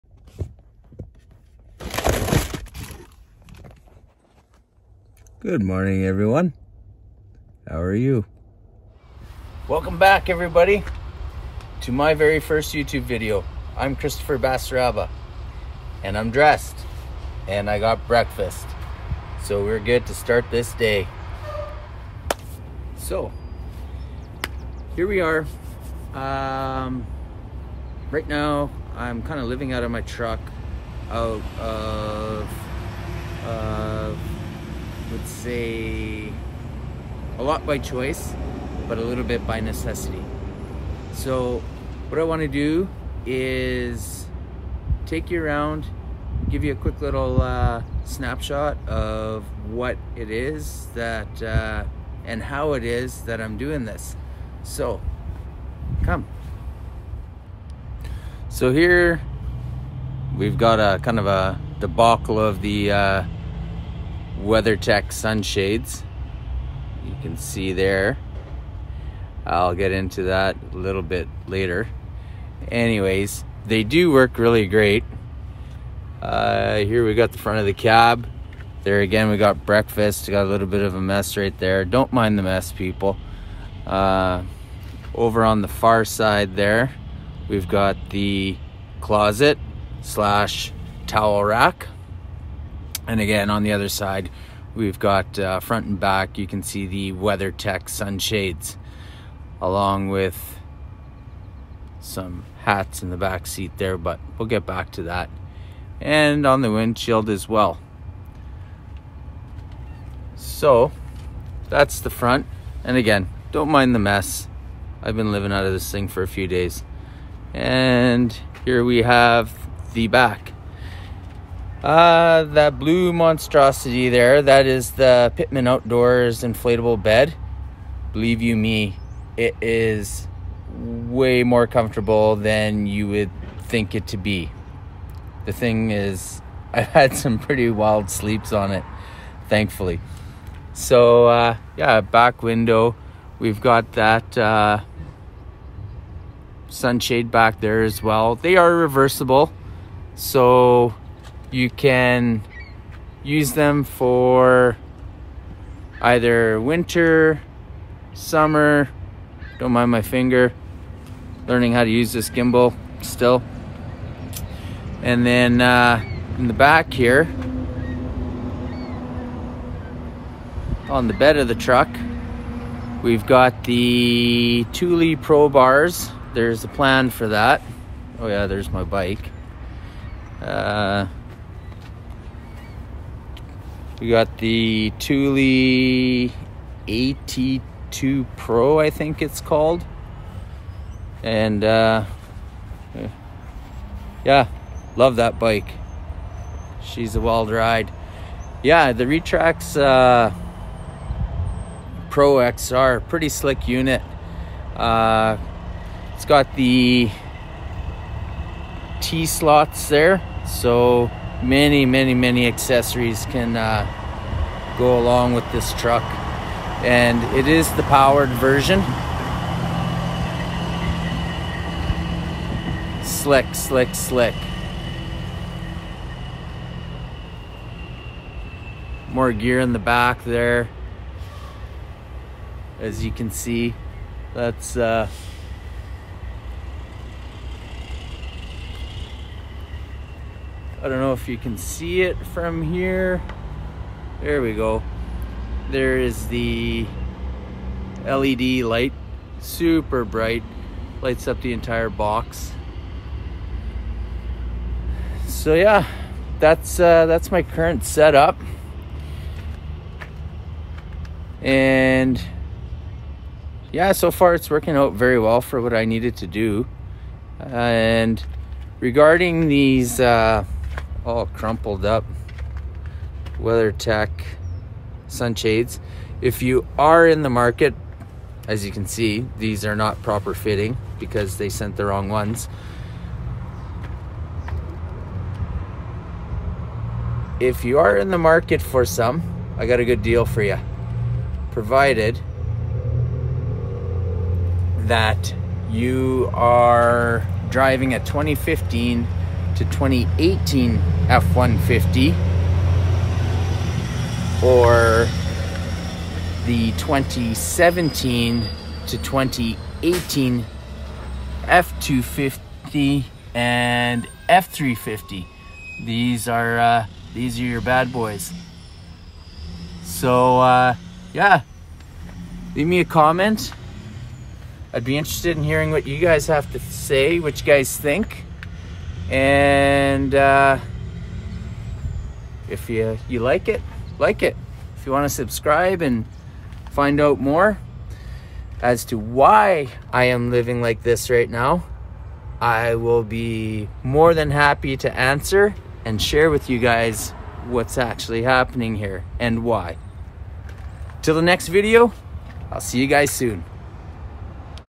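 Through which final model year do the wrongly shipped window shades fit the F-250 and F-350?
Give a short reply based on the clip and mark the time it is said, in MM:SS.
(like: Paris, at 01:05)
2018, at 05:08.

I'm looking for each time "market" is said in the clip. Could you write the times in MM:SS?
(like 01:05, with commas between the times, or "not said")
04:37, 04:48.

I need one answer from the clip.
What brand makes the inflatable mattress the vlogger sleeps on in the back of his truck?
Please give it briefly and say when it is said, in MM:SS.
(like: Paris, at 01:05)
Pittman Outdoors, at 02:05.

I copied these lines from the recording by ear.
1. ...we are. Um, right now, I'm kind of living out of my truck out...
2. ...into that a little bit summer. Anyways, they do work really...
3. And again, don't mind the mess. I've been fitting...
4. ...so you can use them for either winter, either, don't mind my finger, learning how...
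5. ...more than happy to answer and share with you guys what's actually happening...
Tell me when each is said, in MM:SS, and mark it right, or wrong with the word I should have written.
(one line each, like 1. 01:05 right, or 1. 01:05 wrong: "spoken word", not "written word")
1. 00:25 right
2. 01:09 wrong: "later", not "summer"
3. 01:52 wrong: "living", not "fitting"
4. 02:30 wrong: "summer", not "either"
5. 05:43 right.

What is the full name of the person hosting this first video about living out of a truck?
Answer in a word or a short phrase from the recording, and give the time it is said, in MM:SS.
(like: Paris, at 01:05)
Christopher Basaraba, at 00:13.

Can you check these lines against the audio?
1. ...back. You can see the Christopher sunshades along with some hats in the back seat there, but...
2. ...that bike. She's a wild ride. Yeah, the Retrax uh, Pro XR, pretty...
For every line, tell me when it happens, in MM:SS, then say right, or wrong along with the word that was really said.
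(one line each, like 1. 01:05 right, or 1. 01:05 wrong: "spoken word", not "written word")
1. 01:35 wrong: "WeatherTech", not "Christopher"
2. 03:15 right.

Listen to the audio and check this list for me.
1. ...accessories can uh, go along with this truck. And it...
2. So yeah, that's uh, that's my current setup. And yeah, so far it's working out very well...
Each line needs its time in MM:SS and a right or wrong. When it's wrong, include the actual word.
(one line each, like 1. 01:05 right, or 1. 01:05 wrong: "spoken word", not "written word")
1. 03:32 right
2. 04:15 right.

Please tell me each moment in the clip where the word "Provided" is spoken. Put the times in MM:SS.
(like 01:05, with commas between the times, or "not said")
04:51.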